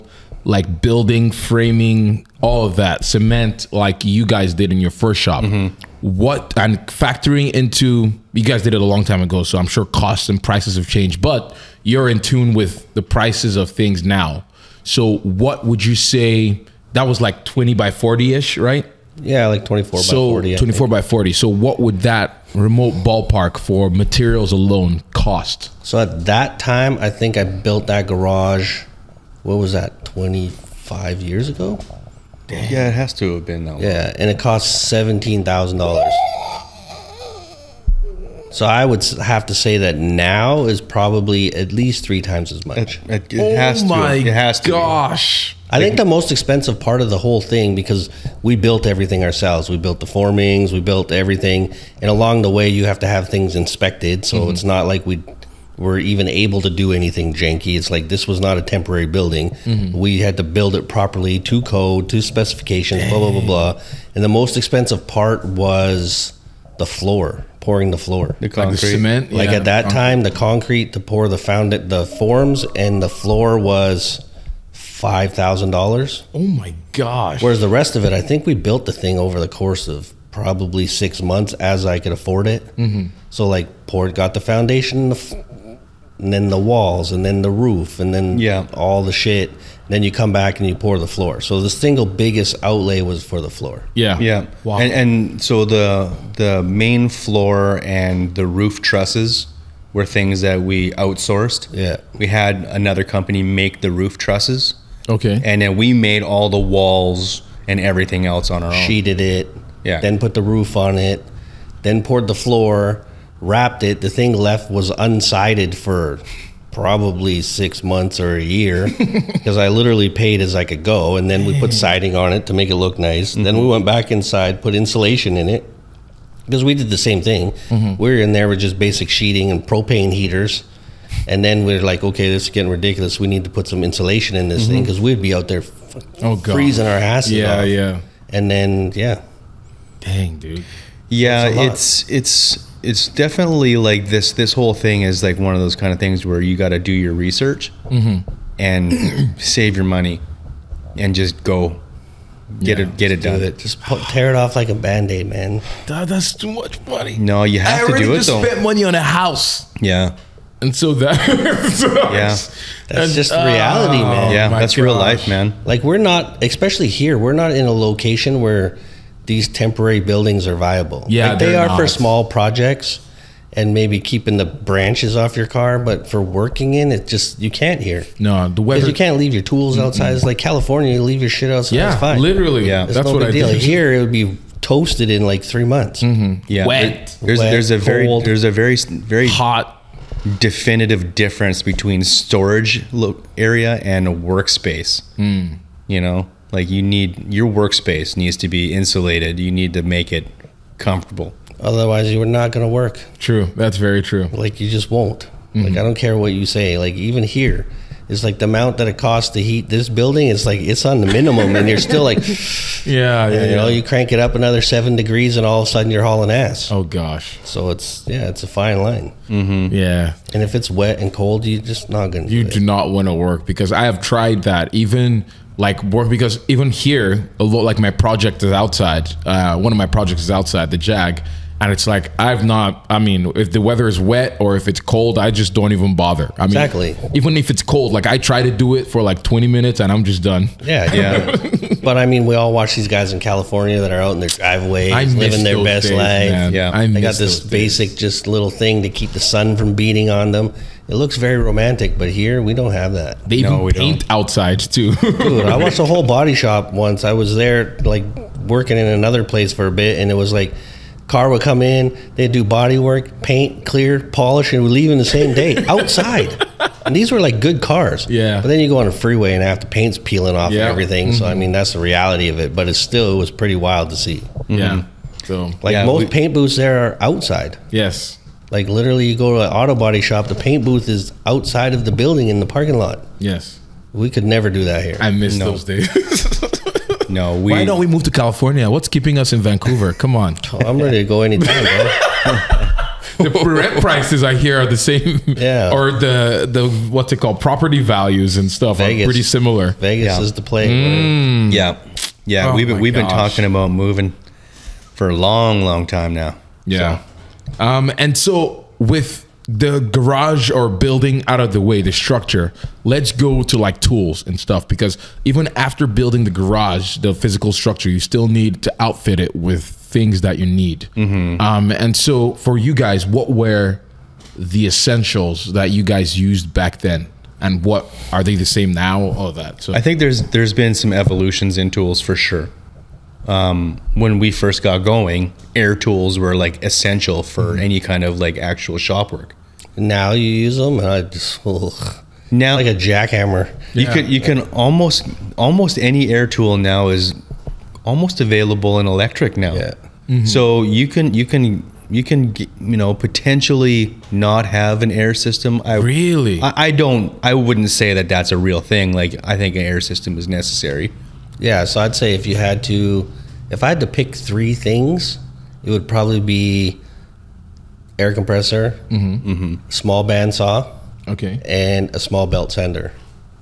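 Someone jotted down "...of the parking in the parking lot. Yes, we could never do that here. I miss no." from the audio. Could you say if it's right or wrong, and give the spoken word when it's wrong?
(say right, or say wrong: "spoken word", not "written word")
wrong: "building", not "parking".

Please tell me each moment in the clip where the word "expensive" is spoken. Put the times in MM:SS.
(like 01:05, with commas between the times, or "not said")
00:46, 01:04.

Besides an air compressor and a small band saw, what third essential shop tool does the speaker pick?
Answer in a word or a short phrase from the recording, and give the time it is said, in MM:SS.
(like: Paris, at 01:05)
small belt sander, at 06:11.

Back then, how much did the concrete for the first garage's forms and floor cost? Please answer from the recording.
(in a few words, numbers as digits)
$5,000.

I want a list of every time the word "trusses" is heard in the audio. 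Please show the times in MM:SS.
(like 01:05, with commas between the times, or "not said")
01:38, 01:44.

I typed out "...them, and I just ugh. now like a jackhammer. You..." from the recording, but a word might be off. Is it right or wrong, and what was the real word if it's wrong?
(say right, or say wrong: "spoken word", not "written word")
right.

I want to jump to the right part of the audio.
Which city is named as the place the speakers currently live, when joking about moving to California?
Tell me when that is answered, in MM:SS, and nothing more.
04:49.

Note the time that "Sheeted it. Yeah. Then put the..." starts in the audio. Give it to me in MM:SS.
01:48.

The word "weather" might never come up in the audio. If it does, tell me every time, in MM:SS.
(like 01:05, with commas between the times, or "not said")
02:58, 03:53.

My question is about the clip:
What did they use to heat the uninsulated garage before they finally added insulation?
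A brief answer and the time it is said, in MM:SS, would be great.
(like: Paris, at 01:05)
propane heaters, at 02:09.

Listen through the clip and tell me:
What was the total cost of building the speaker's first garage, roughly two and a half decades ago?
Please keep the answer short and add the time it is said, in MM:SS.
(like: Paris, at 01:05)
$17,000, at 00:34.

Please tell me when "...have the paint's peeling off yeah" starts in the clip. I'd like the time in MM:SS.
04:29.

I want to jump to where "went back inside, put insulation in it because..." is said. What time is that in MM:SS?
02:03.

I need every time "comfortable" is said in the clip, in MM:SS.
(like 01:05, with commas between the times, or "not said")
03:20.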